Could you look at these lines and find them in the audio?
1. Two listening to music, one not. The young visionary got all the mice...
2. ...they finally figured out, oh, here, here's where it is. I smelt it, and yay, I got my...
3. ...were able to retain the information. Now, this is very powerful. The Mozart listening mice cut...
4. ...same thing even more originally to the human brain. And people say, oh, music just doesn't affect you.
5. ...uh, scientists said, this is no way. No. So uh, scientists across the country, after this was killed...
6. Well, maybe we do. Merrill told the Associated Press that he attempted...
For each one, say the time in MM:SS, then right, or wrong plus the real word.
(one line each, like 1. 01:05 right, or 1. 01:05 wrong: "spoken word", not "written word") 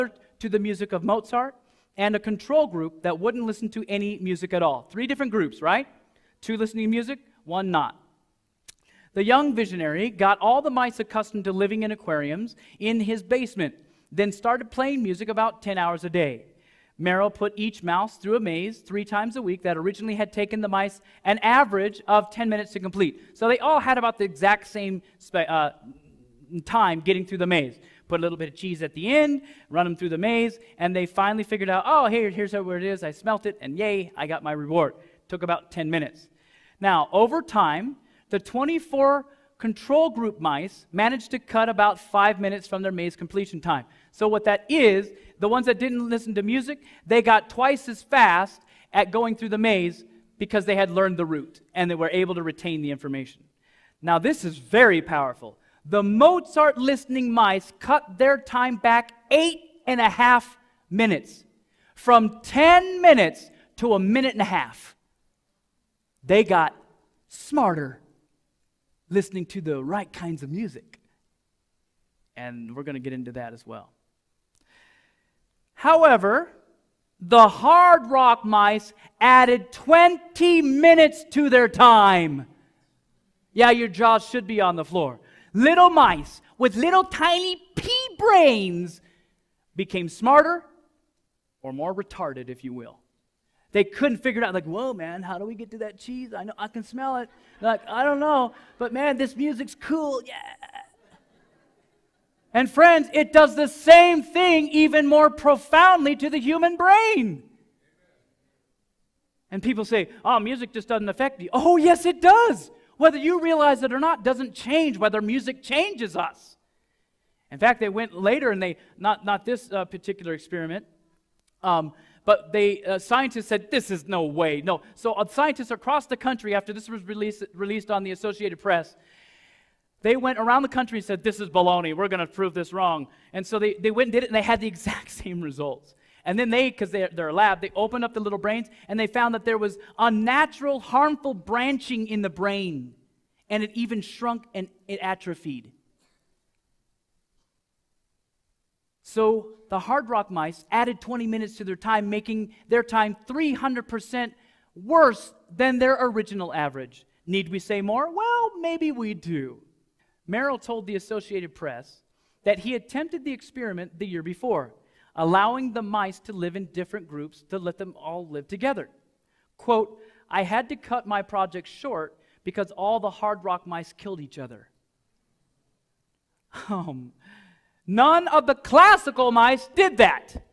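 1. 00:06 right
2. 00:30 right
3. 00:51 right
4. 01:43 wrong: "profoundly", not "originally"
5. 02:02 wrong: "released", not "killed"
6. 02:38 right.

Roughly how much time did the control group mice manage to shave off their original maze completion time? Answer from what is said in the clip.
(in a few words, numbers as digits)
5 minutes.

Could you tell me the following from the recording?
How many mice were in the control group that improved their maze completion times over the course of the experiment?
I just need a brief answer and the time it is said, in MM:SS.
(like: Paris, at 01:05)
24, at 00:38.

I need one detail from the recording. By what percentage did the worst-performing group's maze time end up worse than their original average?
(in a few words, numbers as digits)
300%.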